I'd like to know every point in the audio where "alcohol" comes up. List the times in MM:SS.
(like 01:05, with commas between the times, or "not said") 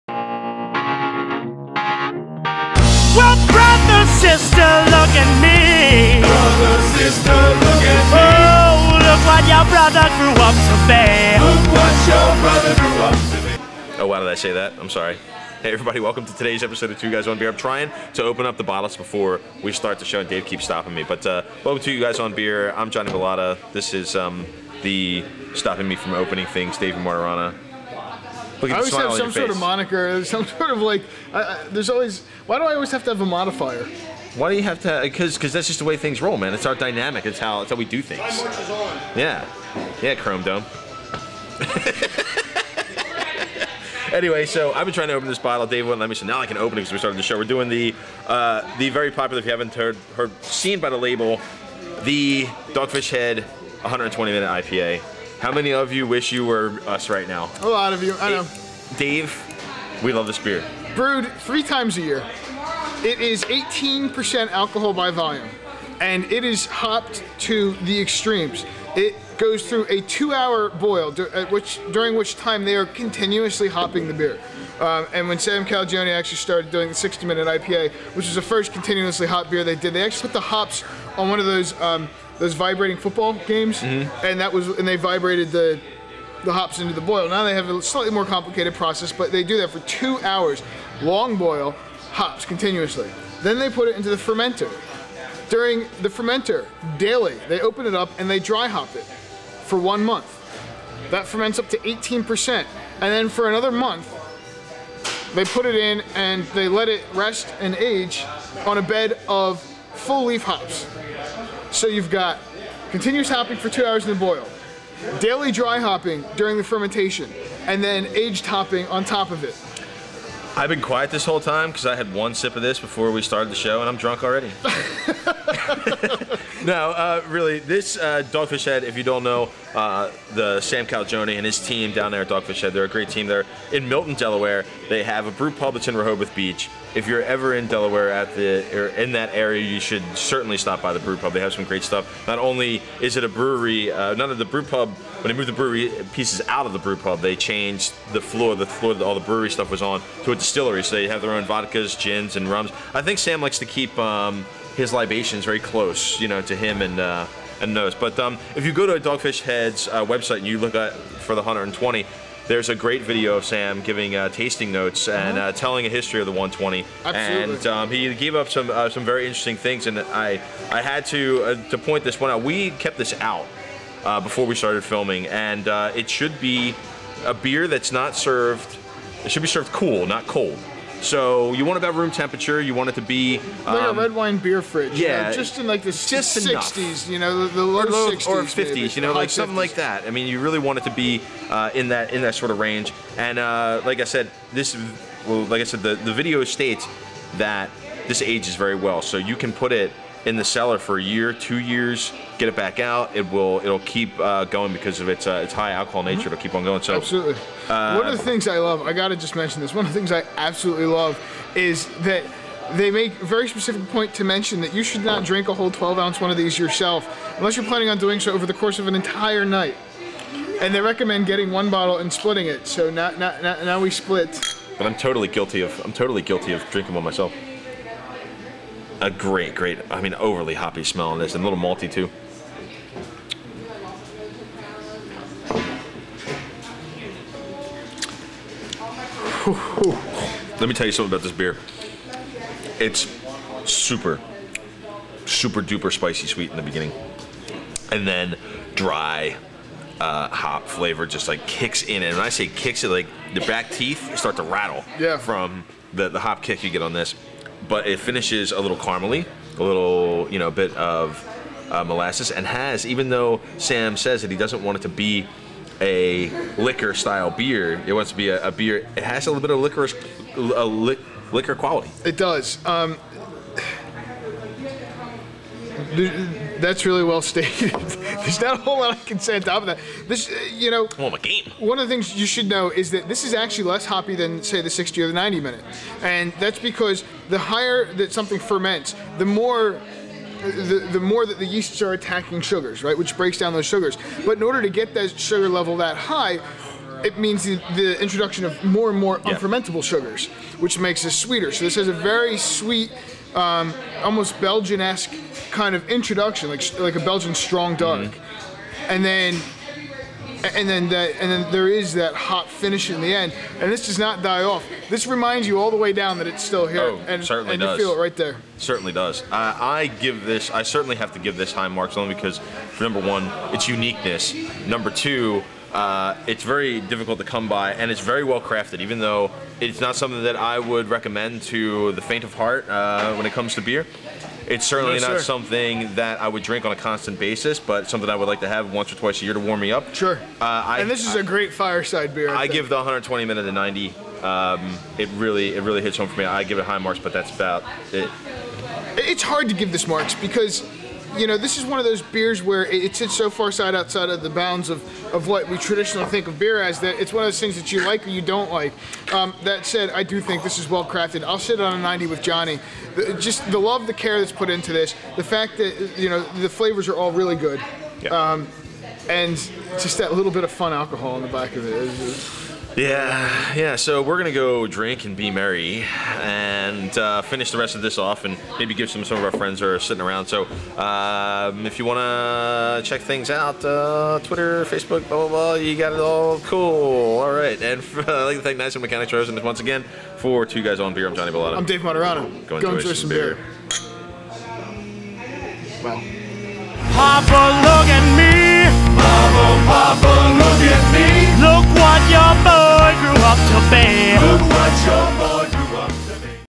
01:04, 03:25, 06:10.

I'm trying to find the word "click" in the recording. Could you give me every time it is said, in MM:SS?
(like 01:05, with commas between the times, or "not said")
not said.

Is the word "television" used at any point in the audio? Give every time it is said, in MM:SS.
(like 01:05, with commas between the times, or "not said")
not said.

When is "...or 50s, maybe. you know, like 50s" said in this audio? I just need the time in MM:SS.
03:08.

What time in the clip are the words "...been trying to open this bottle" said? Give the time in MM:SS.
00:44.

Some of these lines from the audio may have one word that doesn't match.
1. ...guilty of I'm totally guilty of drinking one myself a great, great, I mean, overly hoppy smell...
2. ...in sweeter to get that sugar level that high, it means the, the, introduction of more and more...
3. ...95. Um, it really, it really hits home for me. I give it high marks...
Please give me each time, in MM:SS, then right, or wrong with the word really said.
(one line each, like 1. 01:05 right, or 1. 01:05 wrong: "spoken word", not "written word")
1. 03:45 right
2. 04:54 wrong: "order", not "sweeter"
3. 05:43 wrong: "90", not "95".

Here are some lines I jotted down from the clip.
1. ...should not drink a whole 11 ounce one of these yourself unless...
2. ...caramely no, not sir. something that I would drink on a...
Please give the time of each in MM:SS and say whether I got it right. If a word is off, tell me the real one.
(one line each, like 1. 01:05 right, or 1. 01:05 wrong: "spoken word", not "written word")
1. 03:34 wrong: "12", not "11"
2. 05:34 wrong: "certainly", not "caramely".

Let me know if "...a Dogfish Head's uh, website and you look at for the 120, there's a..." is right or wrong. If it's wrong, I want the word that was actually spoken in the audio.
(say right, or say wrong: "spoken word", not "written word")
right.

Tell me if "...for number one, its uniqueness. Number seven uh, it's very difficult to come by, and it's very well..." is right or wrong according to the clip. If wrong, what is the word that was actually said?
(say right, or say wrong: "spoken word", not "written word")
wrong: "two", not "seven".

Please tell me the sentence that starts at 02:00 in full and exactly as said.
I've been quiet this whole time because I had one sip of this before we started the show, and I'm drunk already.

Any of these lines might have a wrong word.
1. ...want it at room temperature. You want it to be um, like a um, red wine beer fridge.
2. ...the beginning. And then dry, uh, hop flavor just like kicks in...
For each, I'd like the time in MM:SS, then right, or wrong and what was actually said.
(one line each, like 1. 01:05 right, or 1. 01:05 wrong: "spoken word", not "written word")
1. 03:01 right
2. 04:06 right.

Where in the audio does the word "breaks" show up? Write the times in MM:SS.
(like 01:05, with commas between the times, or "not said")
04:53.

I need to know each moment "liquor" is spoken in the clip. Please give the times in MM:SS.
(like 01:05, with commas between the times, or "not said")
04:26, 04:31.